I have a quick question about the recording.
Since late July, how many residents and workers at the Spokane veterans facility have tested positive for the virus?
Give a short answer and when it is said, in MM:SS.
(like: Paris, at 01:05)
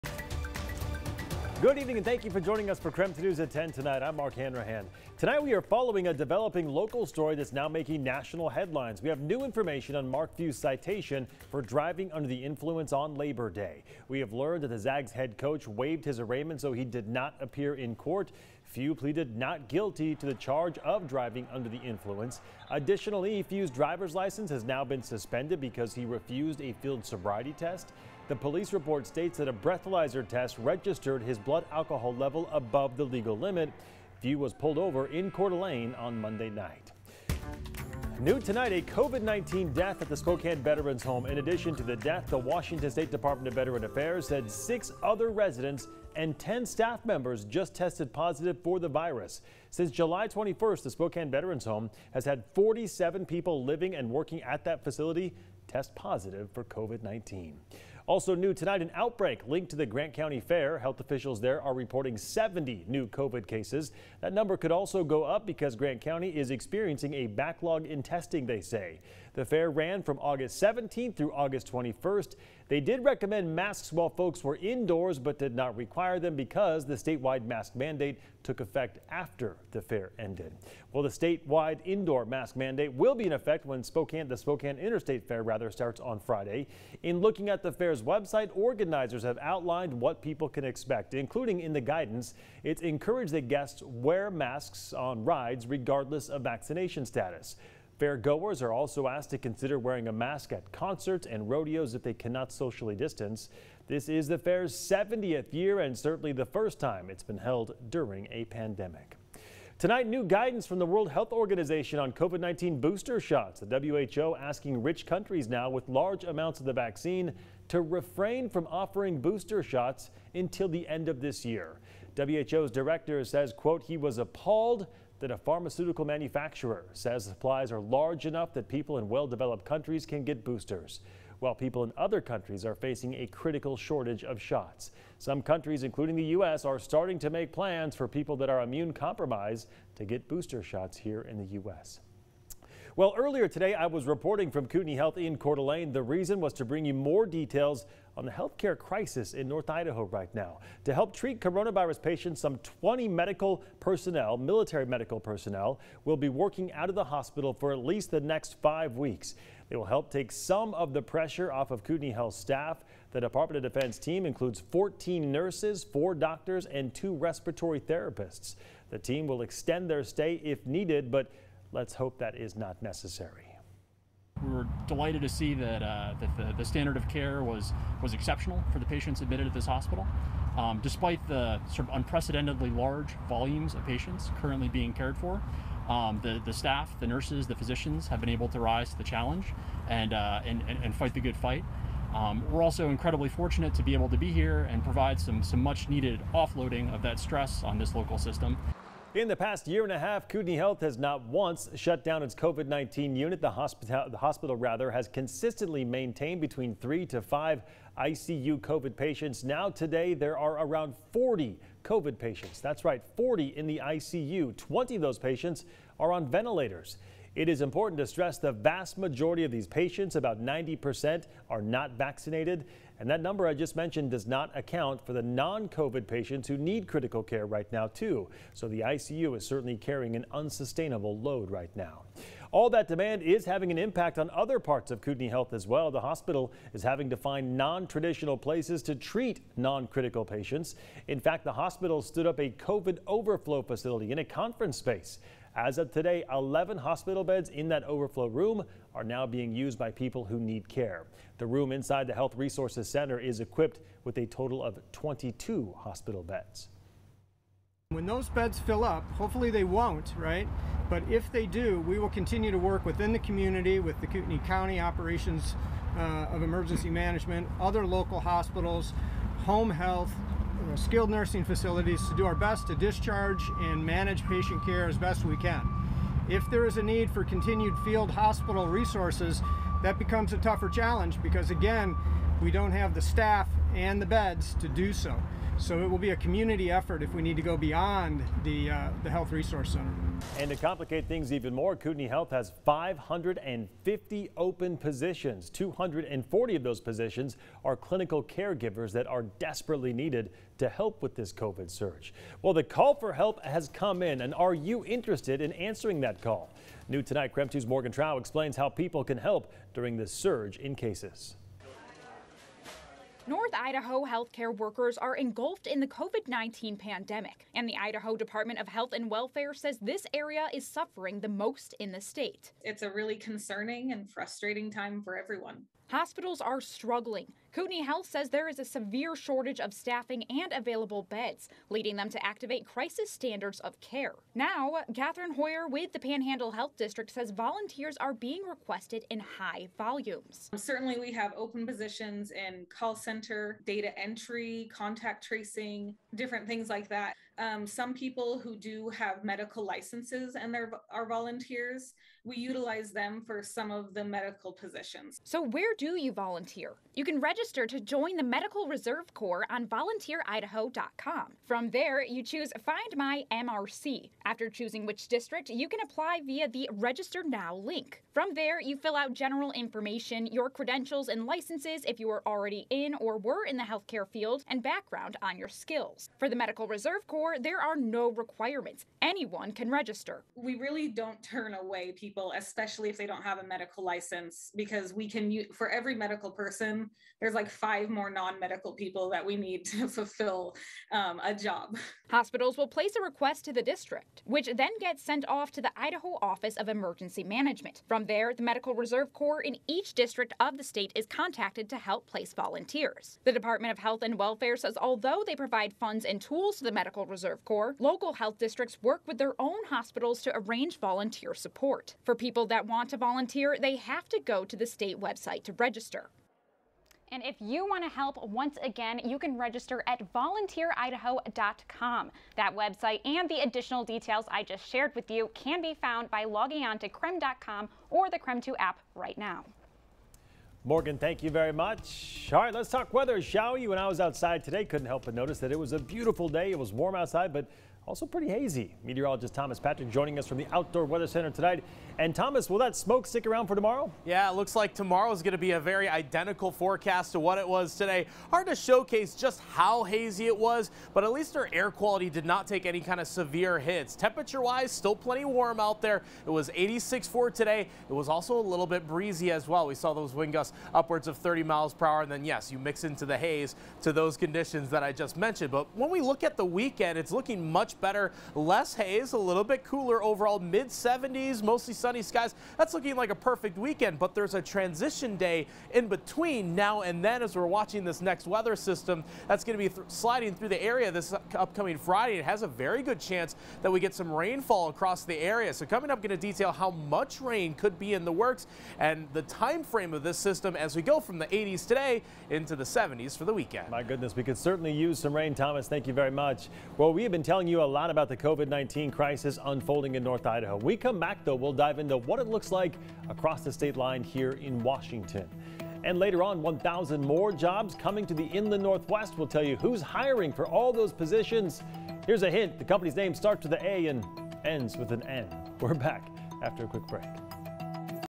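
47, at 00:52.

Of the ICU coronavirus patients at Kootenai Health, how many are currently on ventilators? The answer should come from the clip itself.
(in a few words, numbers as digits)
20.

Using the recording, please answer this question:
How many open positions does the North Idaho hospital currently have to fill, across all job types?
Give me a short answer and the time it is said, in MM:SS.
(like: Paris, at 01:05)
550, at 04:52.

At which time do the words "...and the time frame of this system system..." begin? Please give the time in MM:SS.
08:08.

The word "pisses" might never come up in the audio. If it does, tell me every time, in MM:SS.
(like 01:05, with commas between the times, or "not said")
not said.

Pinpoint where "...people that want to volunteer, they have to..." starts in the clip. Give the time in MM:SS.
06:52.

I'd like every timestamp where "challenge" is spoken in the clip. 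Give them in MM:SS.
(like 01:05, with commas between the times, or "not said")
03:09, 04:40.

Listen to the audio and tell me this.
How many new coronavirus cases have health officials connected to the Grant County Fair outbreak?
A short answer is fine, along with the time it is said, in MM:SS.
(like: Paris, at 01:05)
70, at 01:02.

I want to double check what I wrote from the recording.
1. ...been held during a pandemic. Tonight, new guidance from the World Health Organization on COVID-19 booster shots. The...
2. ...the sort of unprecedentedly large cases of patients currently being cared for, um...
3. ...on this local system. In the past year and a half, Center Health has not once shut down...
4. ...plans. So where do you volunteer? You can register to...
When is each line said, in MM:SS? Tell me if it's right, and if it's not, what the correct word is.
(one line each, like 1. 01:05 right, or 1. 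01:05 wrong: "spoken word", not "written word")
1. 01:47 right
2. 03:01 wrong: "volumes", not "cases"
3. 03:17 wrong: "Kootenai", not "Center"
4. 05:54 wrong: "positions", not "plans".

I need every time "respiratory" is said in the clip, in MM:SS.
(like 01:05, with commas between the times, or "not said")
02:47.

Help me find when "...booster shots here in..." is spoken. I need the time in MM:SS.
02:20.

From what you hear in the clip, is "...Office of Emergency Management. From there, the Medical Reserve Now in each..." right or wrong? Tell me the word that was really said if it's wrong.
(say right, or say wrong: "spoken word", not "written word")
wrong: "Corps", not "Now".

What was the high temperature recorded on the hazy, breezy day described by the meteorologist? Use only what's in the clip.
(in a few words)
86.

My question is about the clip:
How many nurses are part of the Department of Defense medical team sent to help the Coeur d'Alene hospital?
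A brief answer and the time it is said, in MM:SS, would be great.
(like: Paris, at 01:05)
14, at 02:44.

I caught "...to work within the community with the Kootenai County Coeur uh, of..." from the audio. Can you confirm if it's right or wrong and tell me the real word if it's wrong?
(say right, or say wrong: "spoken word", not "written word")
wrong: "Operations", not "Coeur".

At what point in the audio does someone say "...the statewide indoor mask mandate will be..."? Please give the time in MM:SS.
01:21.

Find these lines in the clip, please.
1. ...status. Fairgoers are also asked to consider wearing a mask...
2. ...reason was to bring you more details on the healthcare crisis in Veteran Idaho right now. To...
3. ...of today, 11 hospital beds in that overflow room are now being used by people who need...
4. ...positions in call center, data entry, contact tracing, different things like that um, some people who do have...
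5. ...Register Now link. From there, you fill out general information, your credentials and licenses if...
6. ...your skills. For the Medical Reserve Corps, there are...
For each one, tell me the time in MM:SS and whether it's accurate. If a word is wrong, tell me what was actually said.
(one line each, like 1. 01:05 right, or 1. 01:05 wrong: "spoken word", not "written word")
1. 01:37 right
2. 02:26 wrong: "North", not "Veteran"
3. 04:05 right
4. 05:41 right
5. 06:06 right
6. 06:15 right.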